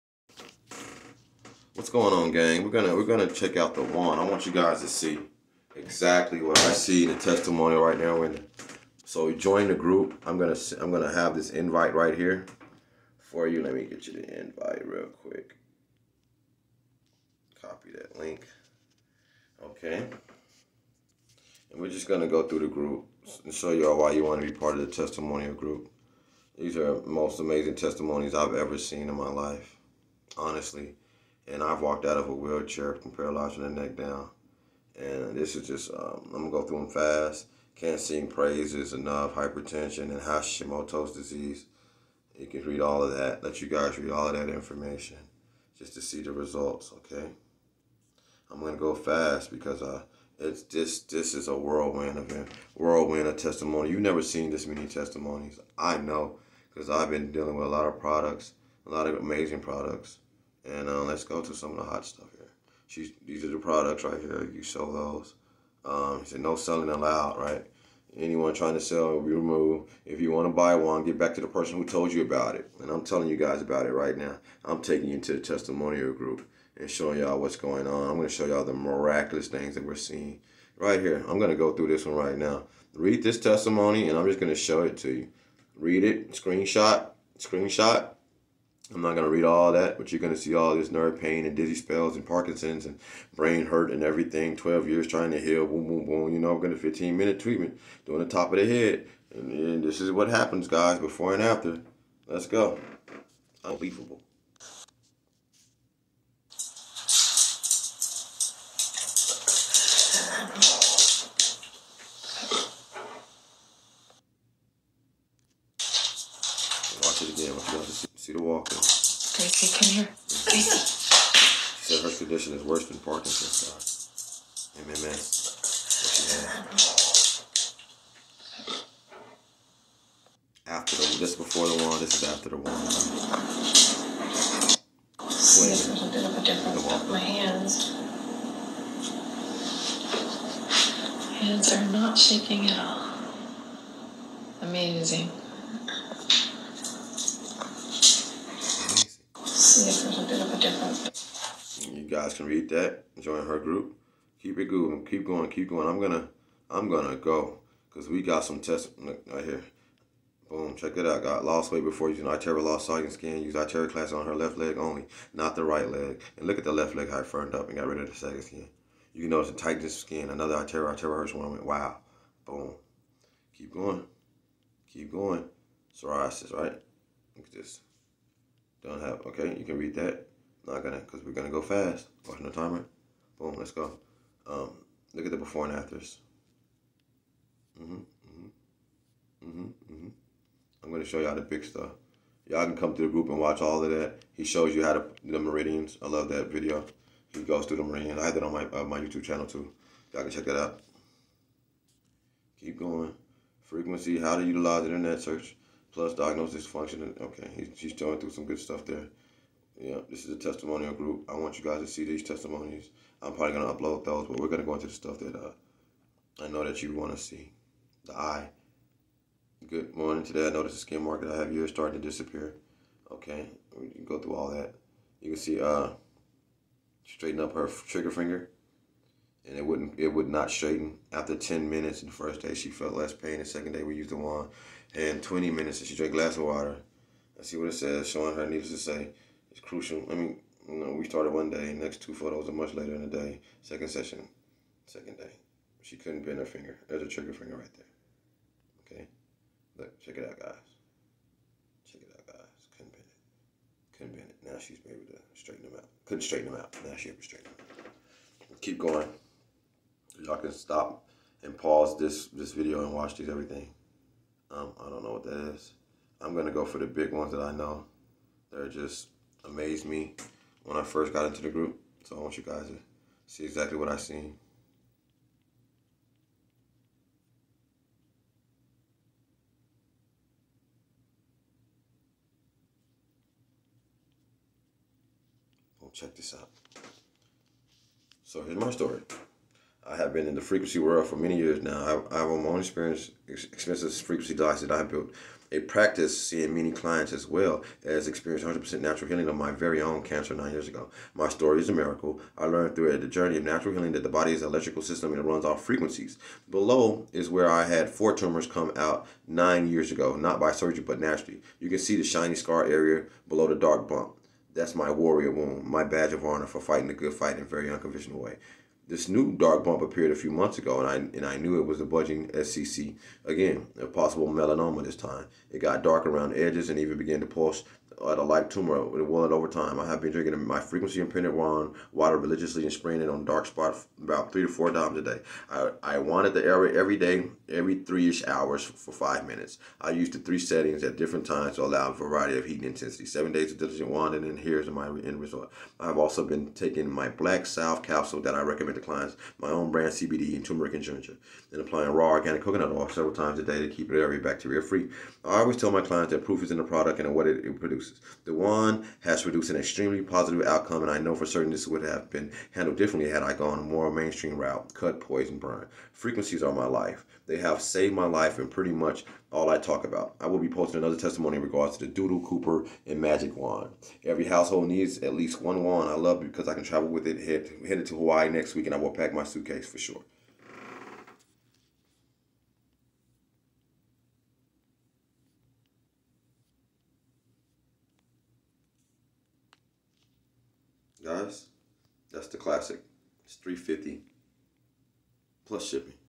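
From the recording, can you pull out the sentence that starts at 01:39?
And, and this is what happens, guys, before and after.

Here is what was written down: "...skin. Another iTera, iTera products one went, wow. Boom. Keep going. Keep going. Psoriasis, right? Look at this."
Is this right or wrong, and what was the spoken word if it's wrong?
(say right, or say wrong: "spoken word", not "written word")
wrong: "hurts", not "products".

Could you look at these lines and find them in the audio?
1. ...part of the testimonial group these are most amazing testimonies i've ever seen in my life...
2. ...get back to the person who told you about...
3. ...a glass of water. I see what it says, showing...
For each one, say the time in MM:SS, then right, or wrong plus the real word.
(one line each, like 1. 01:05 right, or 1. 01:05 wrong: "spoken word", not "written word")
1. 00:24 right
2. 01:11 right
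3. 03:56 right.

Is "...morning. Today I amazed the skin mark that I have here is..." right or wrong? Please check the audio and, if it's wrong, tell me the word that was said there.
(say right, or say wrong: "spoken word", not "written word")
wrong: "noticed", not "amazed".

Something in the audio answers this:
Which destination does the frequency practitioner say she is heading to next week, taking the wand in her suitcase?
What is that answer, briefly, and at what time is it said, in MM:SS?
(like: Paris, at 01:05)
Hawaii, at 06:17.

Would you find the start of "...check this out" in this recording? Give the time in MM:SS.
04:45.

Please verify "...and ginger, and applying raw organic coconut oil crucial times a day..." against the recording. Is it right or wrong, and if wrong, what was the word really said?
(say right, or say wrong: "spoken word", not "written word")
wrong: "several", not "crucial".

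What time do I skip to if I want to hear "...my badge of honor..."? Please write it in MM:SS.
05:15.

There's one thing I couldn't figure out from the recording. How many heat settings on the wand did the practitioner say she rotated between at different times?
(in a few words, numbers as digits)
3 settings.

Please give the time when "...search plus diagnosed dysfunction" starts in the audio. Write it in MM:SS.
03:25.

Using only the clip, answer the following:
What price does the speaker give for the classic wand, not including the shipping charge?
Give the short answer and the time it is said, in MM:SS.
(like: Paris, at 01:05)
$350, at 06:33.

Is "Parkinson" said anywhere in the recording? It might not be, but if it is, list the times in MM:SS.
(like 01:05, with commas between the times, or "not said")
01:32, 02:02.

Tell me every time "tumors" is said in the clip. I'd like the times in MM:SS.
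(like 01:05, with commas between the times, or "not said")
05:08, 05:28.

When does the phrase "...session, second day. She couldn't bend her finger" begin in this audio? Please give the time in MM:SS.
04:03.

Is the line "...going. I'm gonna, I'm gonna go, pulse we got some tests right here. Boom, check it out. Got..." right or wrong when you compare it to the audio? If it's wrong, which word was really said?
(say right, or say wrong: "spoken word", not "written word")
wrong: "cause", not "pulse".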